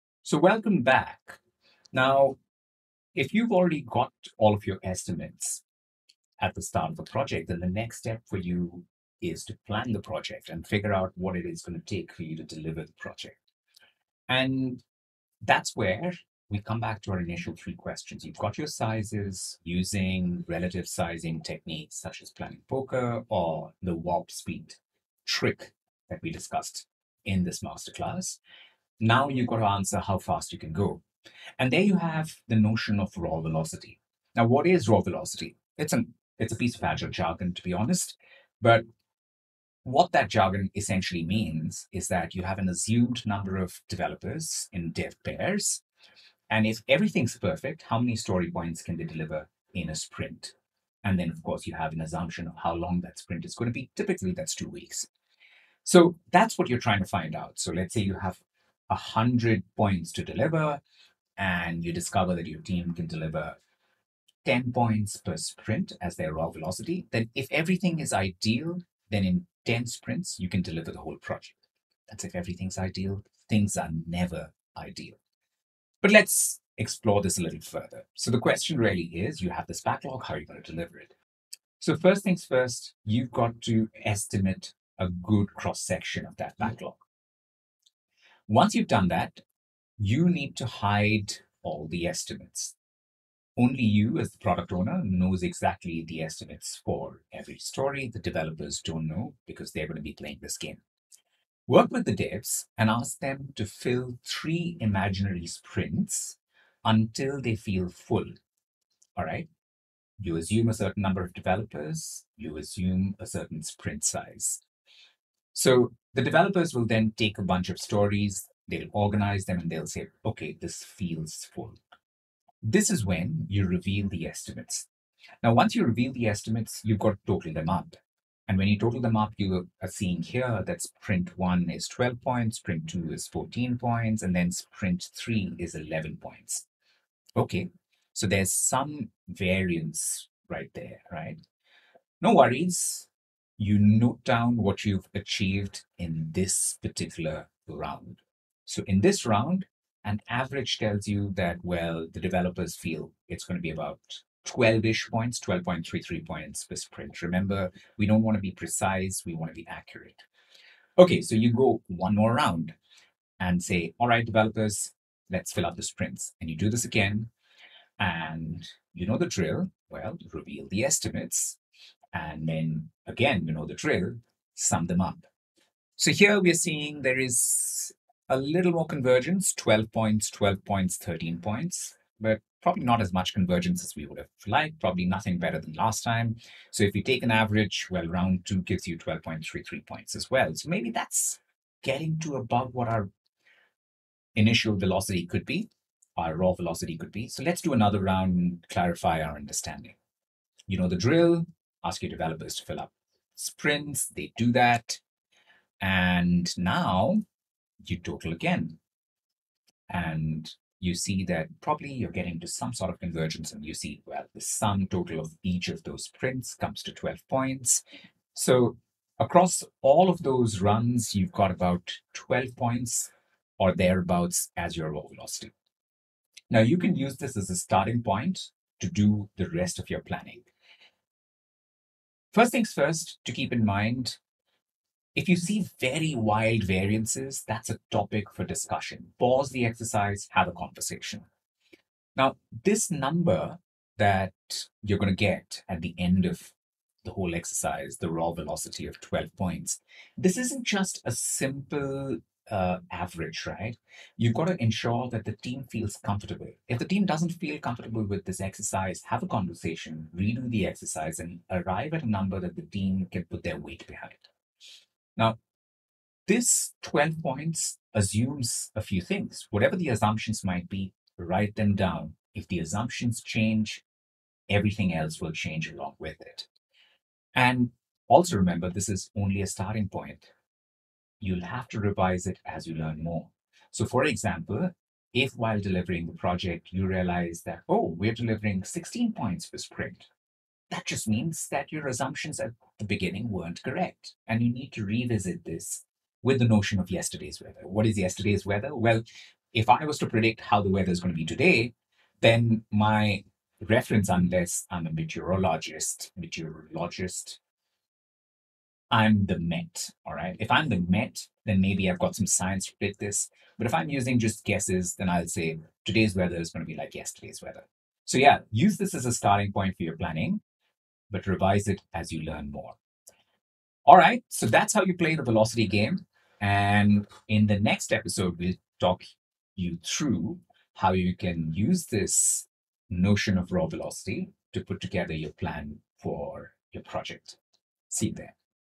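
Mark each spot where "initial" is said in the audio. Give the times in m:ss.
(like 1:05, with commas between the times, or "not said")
0:17, 3:14.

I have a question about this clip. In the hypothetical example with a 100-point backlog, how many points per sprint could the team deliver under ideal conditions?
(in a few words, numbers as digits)
10 points.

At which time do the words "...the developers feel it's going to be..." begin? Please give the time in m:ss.
2:32.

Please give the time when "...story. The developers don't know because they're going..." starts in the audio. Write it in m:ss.
1:37.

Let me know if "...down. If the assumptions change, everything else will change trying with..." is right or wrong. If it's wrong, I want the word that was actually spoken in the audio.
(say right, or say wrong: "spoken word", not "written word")
wrong: "along", not "trying".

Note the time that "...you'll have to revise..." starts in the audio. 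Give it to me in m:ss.
4:41.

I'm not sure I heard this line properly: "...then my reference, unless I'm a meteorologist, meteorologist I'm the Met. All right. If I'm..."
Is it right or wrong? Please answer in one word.
right.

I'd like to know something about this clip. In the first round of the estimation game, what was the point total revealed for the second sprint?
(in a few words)
14 points.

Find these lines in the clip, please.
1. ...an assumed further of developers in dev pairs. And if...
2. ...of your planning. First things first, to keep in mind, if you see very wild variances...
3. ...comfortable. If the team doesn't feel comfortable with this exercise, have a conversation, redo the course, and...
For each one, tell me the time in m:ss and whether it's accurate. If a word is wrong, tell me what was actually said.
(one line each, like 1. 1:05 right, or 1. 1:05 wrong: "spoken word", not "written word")
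1. 0:42 wrong: "number", not "further"
2. 3:49 right
3. 4:16 wrong: "exercise", not "course".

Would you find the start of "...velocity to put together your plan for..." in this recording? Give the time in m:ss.
5:33.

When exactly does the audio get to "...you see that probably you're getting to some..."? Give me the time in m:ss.
3:30.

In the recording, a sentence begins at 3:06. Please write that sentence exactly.
So if you take an average, well, round two gives you 12.33 points as well.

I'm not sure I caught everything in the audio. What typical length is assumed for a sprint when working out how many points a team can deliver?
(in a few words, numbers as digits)
two weeks.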